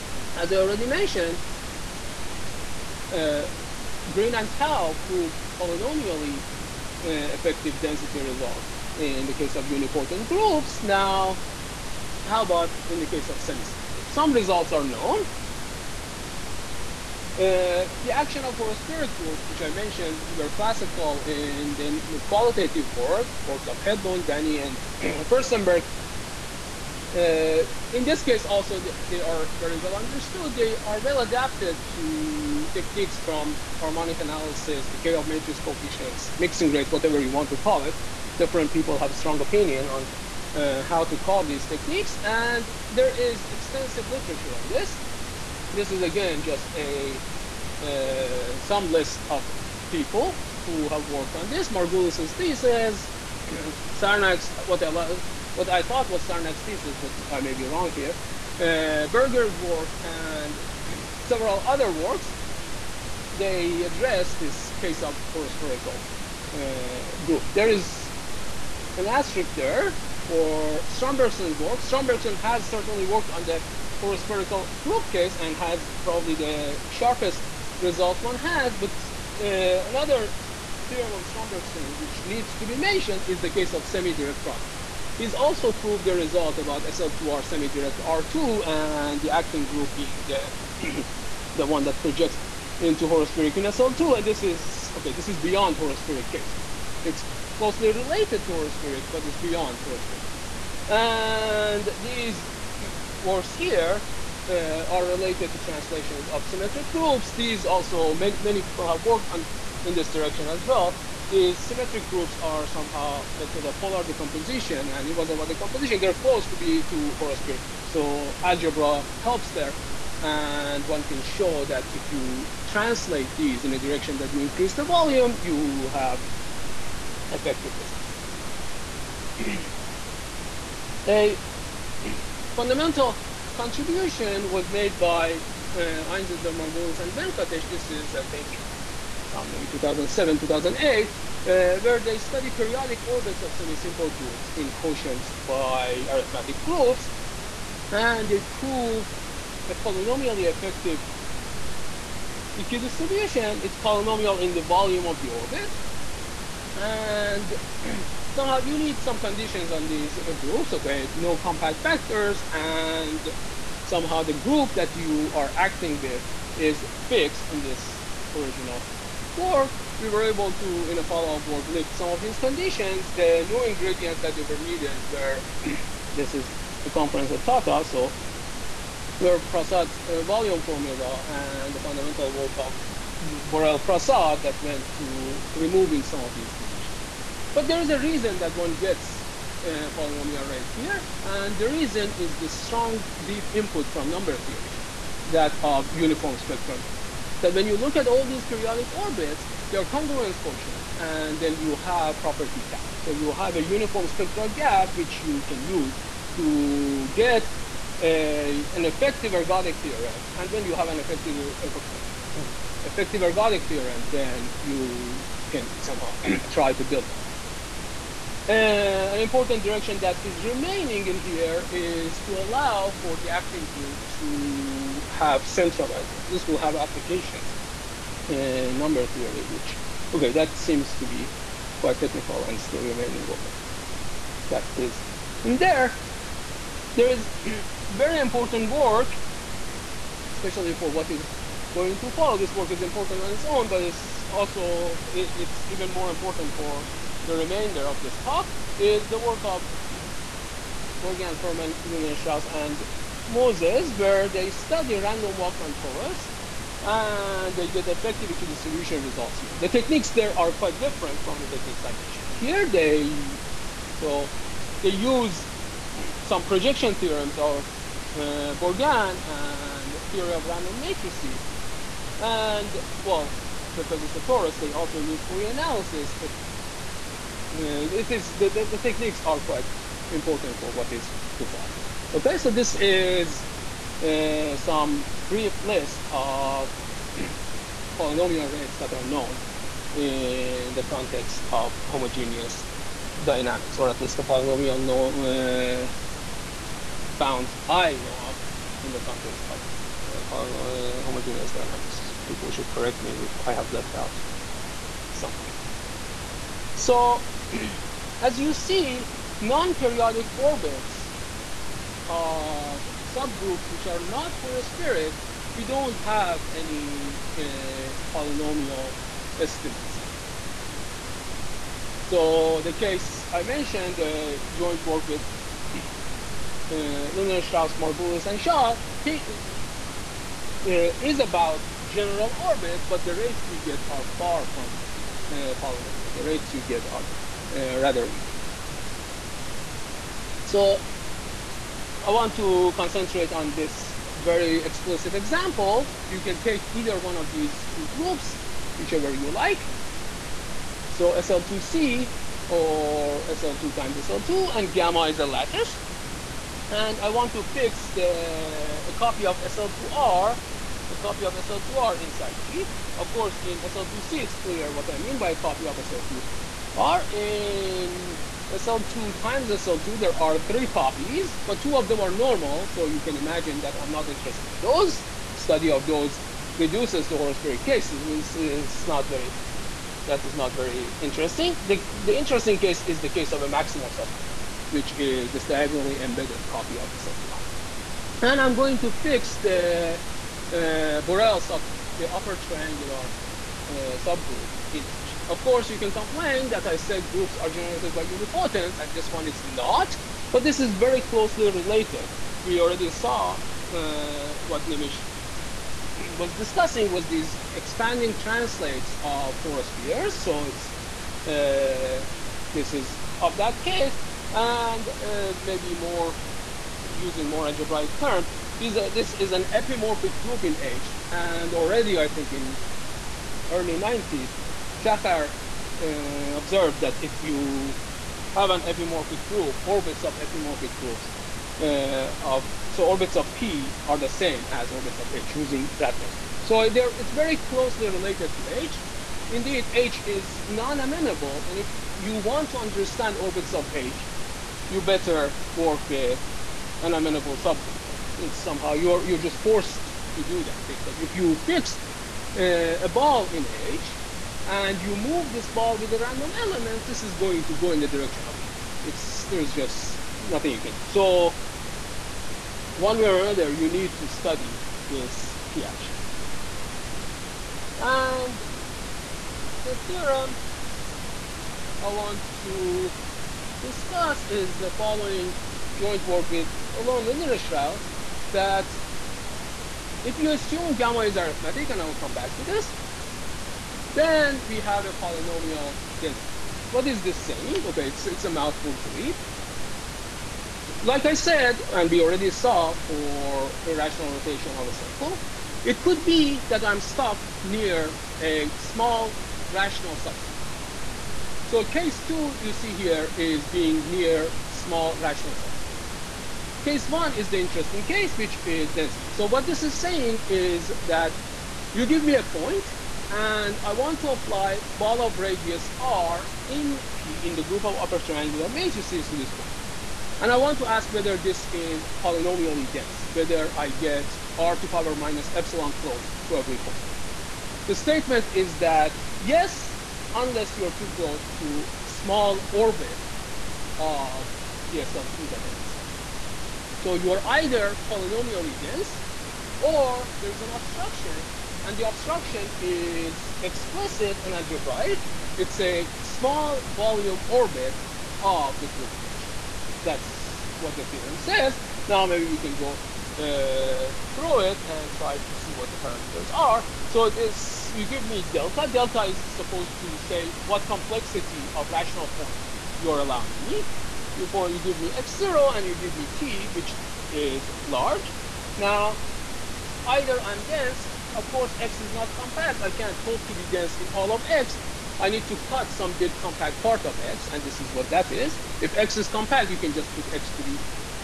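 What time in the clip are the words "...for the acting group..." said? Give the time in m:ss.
3:43.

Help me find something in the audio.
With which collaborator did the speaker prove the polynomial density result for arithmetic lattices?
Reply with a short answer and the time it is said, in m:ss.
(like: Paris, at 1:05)
Elon Lindenstrauss, at 7:56.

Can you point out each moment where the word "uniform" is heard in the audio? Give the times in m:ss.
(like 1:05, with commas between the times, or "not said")
3:15, 3:23.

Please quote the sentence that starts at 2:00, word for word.
And one can show that if you translate these in a direction that you increase the volume, you have effective results.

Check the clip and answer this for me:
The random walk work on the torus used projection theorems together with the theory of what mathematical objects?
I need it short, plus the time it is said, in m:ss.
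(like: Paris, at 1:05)
random matrices, at 4:30.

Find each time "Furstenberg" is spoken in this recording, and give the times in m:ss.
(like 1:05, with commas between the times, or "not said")
0:25.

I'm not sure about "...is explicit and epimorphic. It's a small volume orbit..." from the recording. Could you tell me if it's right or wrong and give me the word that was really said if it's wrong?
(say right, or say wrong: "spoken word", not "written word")
wrong: "algebraic", not "epimorphic".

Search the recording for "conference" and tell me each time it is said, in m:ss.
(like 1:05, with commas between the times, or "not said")
2:56.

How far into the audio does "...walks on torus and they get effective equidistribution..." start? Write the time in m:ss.
4:15.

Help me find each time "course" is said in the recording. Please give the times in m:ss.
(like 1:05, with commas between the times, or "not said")
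6:03, 6:35, 9:31.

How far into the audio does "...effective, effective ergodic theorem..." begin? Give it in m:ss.
3:30.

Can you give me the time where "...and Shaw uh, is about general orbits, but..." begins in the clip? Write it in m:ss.
5:28.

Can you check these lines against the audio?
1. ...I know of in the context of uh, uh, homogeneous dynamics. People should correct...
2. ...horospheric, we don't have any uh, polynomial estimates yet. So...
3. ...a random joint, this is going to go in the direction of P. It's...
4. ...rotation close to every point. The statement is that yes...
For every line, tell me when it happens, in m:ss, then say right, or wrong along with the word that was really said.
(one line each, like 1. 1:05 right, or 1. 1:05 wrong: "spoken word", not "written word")
1. 4:57 right
2. 5:14 right
3. 7:35 wrong: "element", not "joint"
4. 8:45 wrong: "epsilon", not "rotation".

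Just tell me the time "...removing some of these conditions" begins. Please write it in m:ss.
3:05.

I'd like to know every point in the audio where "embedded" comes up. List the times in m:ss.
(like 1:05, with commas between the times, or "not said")
6:25.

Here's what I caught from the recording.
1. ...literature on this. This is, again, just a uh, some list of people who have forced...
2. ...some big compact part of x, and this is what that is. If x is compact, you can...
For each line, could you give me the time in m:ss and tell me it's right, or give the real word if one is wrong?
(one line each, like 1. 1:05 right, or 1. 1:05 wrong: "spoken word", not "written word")
1. 0:44 wrong: "worked", not "forced"
2. 9:35 right.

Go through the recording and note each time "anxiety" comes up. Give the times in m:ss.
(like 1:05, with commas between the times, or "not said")
not said.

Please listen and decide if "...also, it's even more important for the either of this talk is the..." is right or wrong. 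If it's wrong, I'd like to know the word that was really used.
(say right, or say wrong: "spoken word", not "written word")
wrong: "remainder", not "either".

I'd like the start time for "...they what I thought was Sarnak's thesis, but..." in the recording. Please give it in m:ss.
0:54.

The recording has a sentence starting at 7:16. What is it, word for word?
So it's very closely related to H.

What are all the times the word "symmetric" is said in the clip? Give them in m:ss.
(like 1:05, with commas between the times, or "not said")
1:46, 1:51.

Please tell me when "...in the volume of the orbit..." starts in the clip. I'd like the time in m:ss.
2:34.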